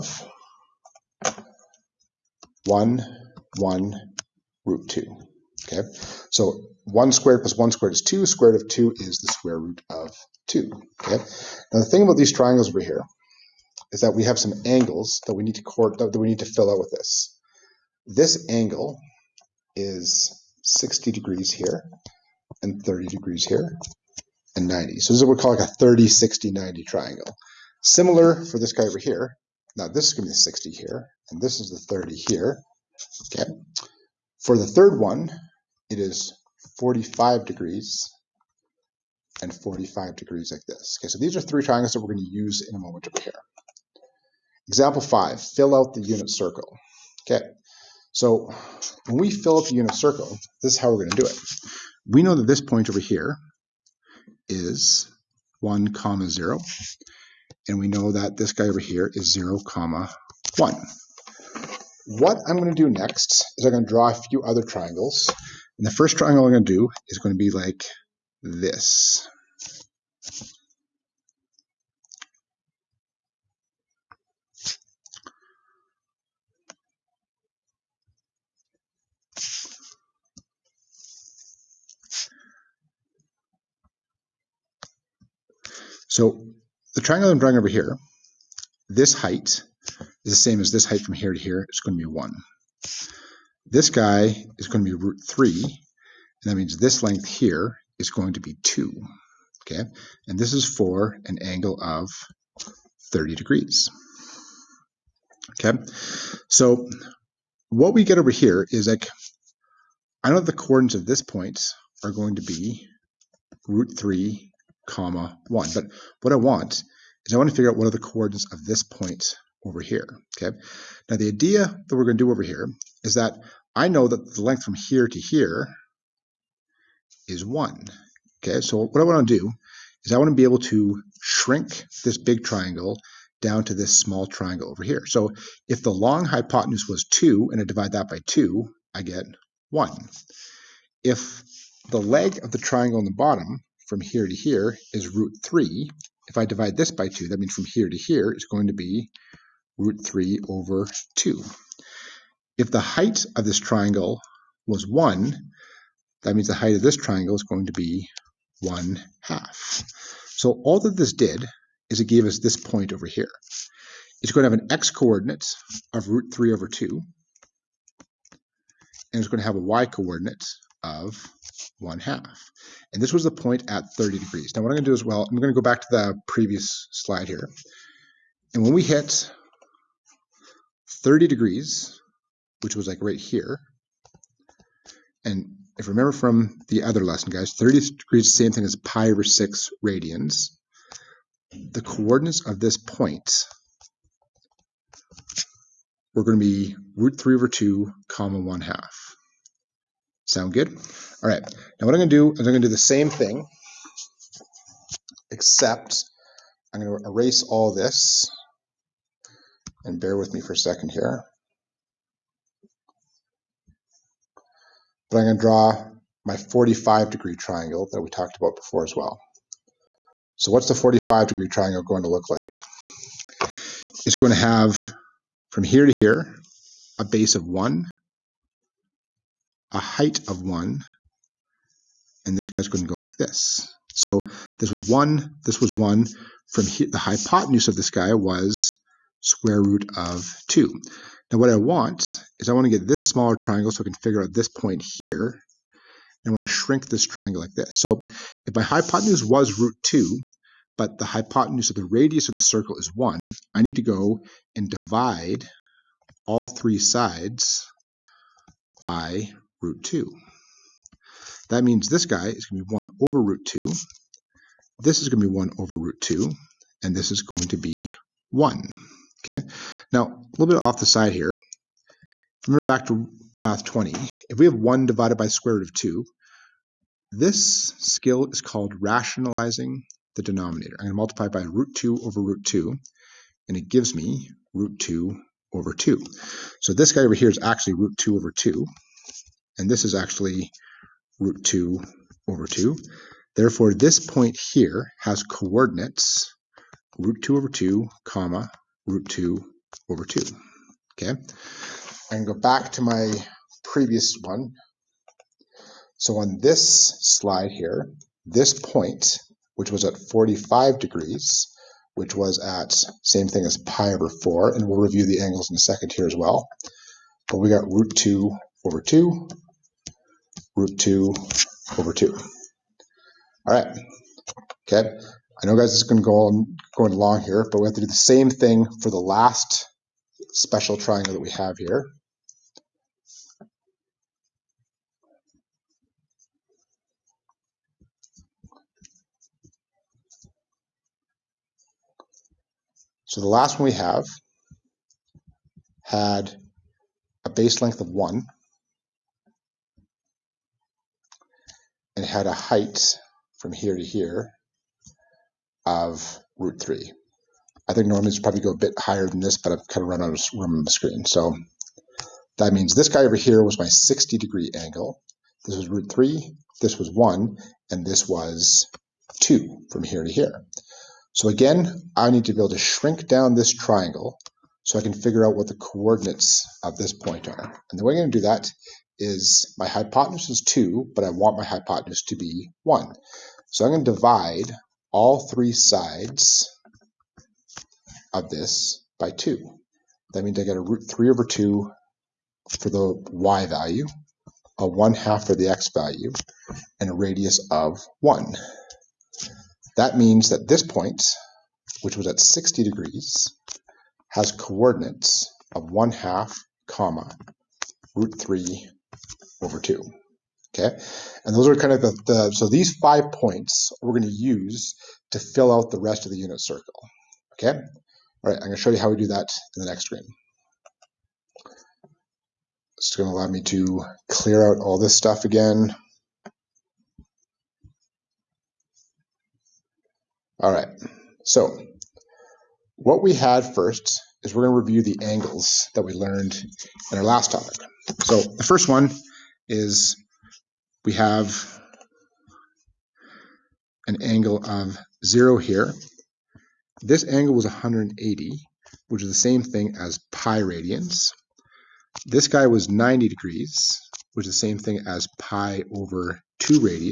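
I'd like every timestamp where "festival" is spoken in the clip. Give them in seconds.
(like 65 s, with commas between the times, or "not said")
not said.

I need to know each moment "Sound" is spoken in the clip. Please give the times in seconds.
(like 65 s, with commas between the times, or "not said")
200 s.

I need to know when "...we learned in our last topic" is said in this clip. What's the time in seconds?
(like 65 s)
435 s.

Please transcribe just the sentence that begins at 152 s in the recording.
If the height of this triangle was 1, that means the height of this triangle is going to be 1 half.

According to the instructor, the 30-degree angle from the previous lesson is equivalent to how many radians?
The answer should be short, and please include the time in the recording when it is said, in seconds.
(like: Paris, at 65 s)
pi over 6, at 188 s.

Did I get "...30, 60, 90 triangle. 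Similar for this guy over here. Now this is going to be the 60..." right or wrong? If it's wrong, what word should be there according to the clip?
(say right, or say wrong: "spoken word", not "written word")
right.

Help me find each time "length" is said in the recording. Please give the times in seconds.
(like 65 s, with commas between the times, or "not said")
97 s, 124 s, 347 s.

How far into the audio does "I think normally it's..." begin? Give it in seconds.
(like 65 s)
357 s.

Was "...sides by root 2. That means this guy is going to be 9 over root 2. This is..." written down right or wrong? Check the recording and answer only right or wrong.
wrong.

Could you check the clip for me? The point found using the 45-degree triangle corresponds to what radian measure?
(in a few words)
pi over 4.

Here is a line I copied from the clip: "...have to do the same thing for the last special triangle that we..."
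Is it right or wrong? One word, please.
right.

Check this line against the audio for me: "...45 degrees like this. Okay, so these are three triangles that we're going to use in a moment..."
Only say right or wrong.
right.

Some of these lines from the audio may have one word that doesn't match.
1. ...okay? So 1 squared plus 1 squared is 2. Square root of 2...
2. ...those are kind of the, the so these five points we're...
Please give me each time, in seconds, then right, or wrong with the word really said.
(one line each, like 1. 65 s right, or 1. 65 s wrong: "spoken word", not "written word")
1. 5 s right
2. 411 s right.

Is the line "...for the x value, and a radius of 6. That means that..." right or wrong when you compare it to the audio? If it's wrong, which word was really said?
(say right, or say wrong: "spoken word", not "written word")
wrong: "1", not "6".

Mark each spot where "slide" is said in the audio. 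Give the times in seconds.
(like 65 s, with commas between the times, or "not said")
176 s, 306 s.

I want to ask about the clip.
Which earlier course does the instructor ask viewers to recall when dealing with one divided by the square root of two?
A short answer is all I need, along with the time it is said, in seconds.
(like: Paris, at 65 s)
math 20, at 273 s.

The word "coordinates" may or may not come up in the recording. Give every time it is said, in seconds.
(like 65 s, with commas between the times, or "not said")
110 s, 117 s, 164 s, 169 s, 191 s, 295 s, 375 s, 404 s.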